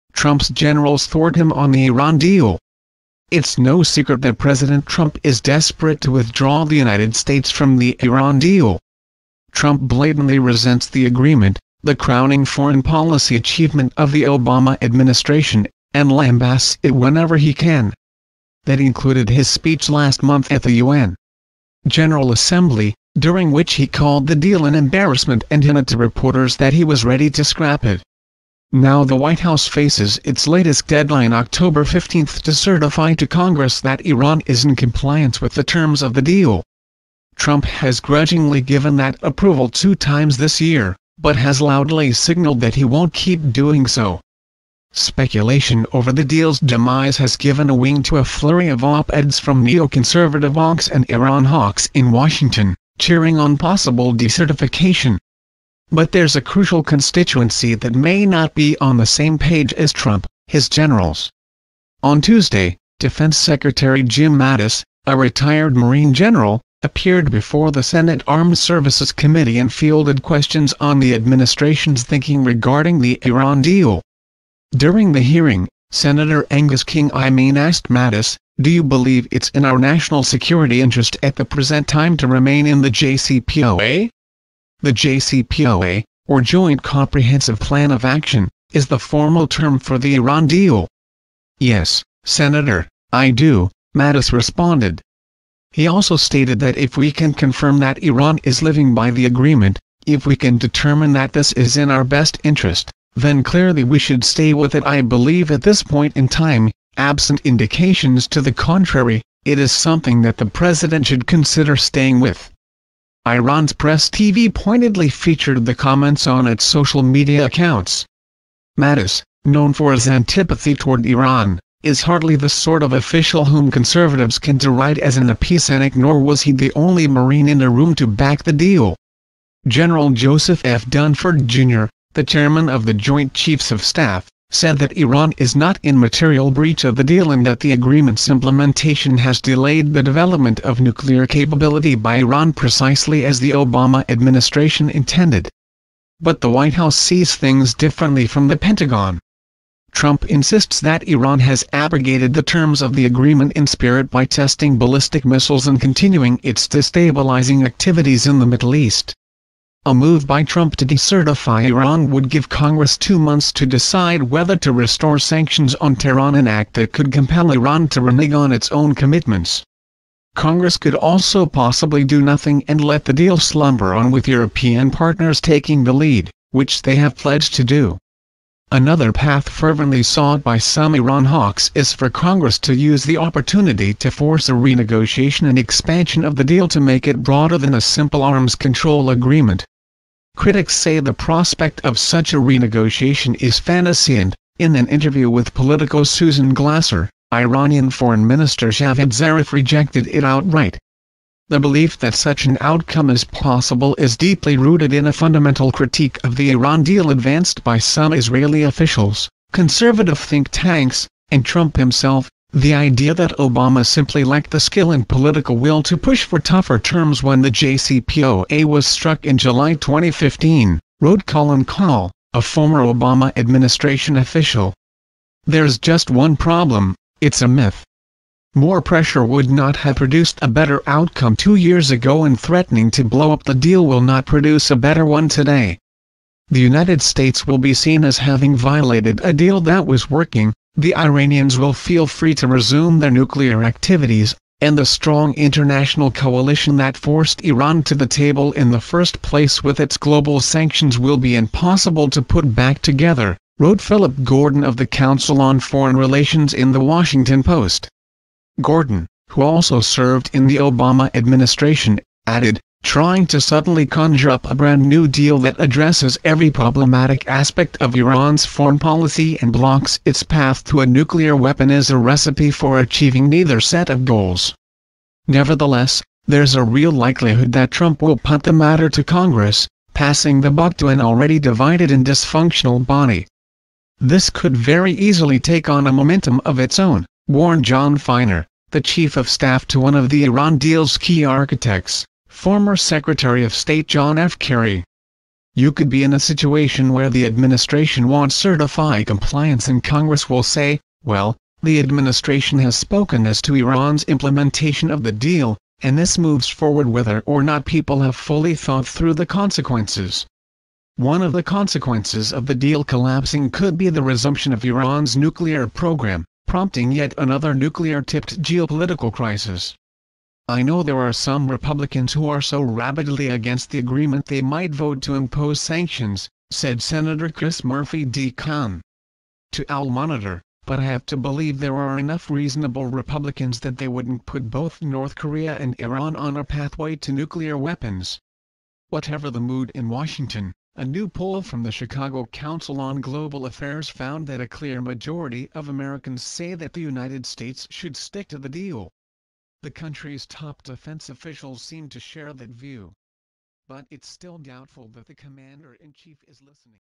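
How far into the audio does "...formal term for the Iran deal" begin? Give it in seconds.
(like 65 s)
88 s.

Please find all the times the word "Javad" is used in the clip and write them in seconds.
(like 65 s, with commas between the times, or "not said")
198 s.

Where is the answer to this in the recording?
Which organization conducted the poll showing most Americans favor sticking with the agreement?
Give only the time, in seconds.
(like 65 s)
341 s.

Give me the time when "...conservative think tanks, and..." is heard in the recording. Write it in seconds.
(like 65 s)
209 s.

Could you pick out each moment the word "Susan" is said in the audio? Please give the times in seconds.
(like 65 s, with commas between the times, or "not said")
196 s.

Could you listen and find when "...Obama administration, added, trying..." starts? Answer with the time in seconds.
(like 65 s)
260 s.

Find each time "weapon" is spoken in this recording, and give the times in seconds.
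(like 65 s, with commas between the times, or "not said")
271 s, 337 s.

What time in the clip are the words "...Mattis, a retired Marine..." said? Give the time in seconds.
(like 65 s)
64 s.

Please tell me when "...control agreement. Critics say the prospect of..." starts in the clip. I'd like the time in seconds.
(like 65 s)
188 s.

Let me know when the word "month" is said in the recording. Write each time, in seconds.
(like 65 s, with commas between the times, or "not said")
20 s, 163 s.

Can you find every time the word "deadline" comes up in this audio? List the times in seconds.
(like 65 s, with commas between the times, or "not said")
30 s.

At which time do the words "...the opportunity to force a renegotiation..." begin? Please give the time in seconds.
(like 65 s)
183 s.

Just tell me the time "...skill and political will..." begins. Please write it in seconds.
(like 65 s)
214 s.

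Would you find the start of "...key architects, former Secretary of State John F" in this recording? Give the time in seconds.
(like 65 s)
290 s.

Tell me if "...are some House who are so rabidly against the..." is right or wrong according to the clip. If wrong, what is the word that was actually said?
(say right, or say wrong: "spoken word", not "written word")
wrong: "Republicans", not "House".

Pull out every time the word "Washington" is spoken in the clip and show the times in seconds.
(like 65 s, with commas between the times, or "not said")
52 s, 256 s, 339 s.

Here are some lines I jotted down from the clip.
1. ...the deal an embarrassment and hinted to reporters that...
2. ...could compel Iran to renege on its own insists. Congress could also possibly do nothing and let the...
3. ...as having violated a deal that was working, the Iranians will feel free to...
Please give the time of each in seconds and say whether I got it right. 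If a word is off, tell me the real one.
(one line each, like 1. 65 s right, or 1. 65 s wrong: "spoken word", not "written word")
1. 24 s right
2. 166 s wrong: "commitments", not "insists"
3. 238 s right.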